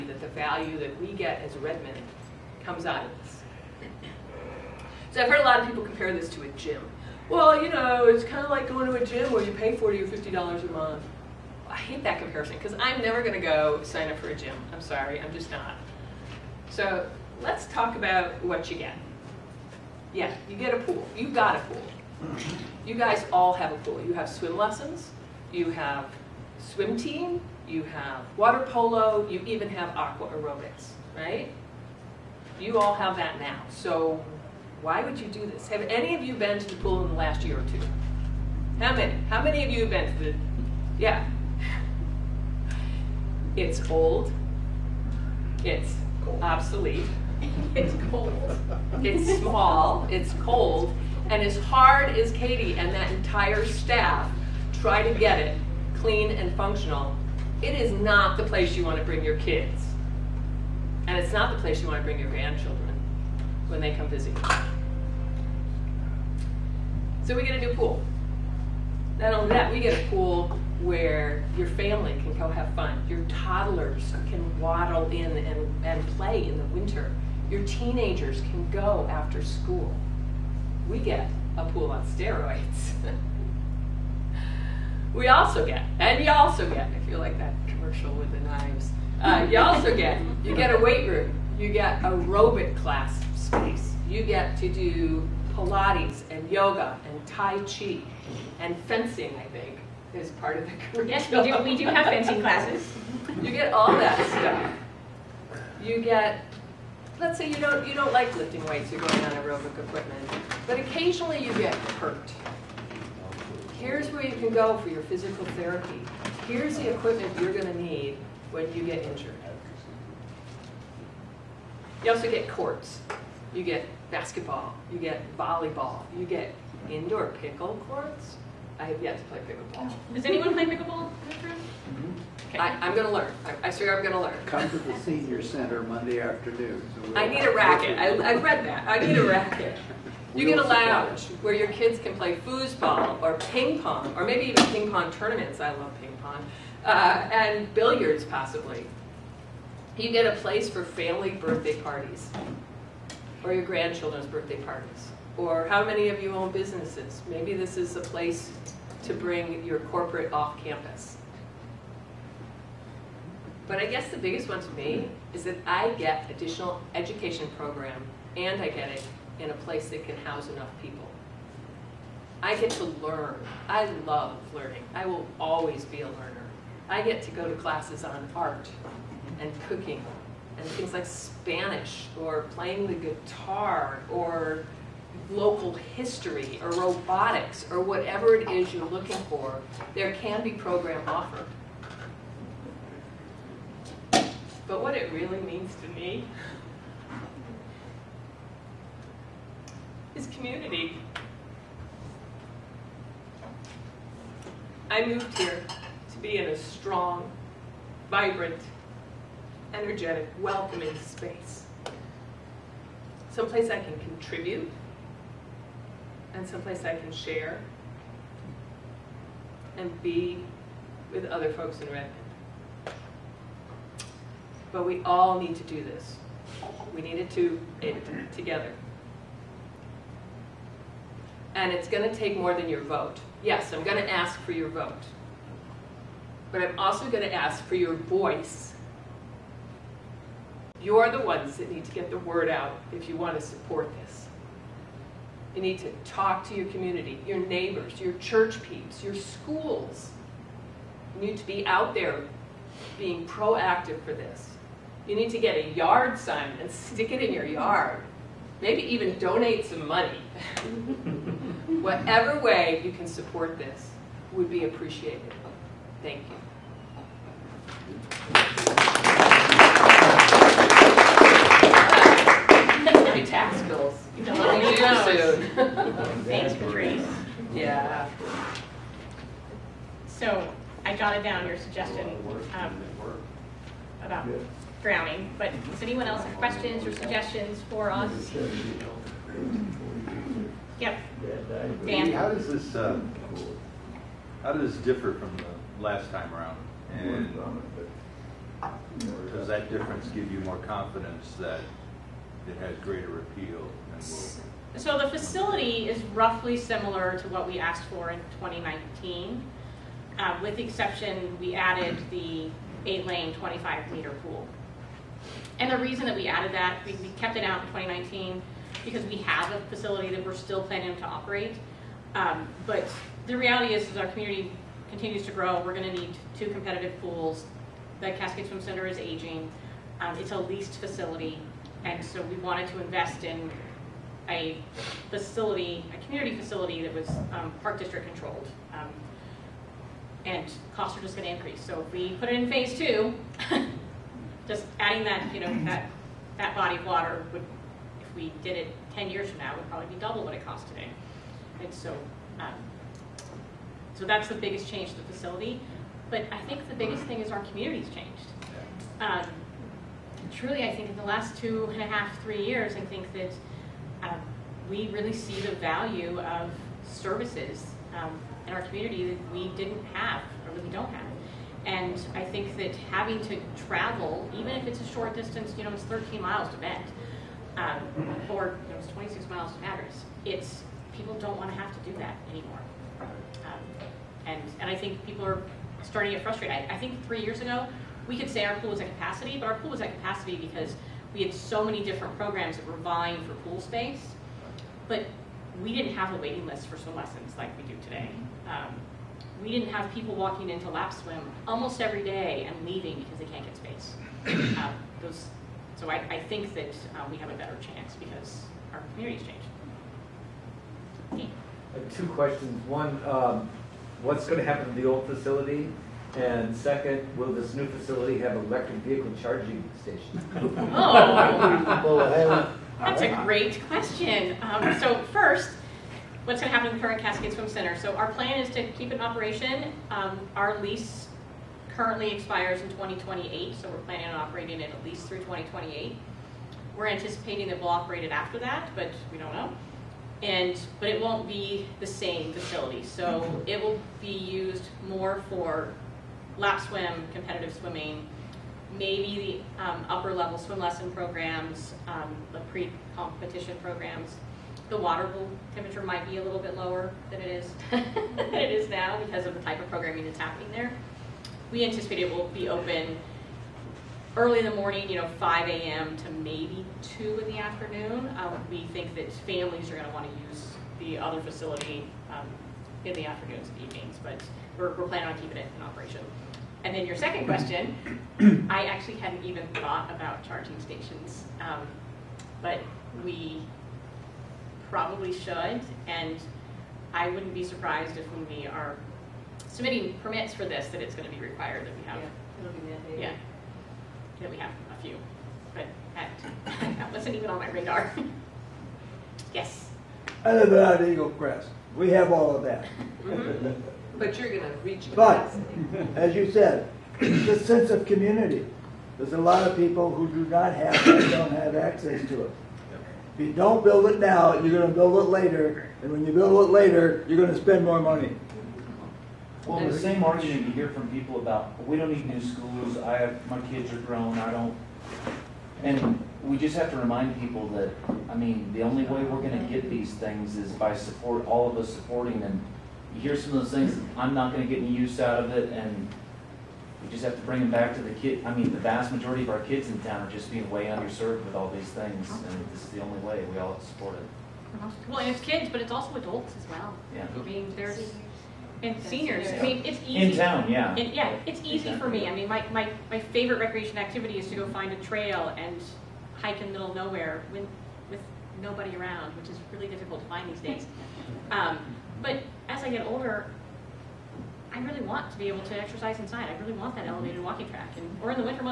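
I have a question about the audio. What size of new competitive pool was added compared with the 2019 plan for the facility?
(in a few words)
eight-lane 25-meter pool.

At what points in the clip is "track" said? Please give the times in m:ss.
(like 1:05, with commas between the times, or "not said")
9:27.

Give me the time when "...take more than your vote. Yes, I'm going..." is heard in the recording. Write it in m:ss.
3:52.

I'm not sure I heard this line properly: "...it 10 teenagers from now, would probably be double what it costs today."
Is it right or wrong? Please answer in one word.
wrong.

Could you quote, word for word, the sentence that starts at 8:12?
Yeah, yeah that we have a few, but that, that wasn't even on my radar.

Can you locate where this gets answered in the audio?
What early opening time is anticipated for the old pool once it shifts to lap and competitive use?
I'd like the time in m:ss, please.
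7:45.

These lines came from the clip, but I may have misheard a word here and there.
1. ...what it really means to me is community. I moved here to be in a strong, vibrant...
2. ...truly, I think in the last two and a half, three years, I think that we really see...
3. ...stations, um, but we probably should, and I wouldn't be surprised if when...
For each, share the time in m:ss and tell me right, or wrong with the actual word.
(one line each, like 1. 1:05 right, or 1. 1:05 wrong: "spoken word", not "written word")
1. 3:14 right
2. 6:00 right
3. 8:00 right.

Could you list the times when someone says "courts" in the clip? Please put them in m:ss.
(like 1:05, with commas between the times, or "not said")
2:02, 2:07.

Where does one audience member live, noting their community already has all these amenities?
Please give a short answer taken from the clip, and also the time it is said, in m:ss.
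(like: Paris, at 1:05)
Eagle Crest, at 8:20.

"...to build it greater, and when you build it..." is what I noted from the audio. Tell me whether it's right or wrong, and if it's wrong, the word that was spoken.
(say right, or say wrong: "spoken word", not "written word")
wrong: "later", not "greater".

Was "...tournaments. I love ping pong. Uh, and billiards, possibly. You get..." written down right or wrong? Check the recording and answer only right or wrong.
right.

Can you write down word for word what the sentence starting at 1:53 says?
Here's where you can go for your physical therapy.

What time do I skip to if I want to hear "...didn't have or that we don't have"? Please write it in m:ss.
6:09.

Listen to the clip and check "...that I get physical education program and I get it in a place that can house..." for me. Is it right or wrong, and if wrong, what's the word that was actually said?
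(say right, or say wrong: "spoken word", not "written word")
wrong: "additional", not "physical".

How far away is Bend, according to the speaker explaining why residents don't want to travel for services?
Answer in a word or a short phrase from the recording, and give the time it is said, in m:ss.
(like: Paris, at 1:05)
13 miles, at 6:15.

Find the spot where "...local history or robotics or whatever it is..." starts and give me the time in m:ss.
3:05.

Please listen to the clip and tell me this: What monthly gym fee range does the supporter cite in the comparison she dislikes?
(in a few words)
$40 to $50.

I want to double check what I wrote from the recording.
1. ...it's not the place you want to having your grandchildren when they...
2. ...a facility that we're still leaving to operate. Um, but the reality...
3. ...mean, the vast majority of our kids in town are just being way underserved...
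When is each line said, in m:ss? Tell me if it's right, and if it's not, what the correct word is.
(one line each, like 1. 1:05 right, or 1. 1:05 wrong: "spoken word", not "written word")
1. 1:01 wrong: "bring", not "having"
2. 5:19 wrong: "planning", not "leaving"
3. 8:58 right.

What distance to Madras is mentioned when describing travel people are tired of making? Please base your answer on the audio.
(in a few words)
26 miles.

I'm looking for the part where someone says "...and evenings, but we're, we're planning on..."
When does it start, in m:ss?
7:53.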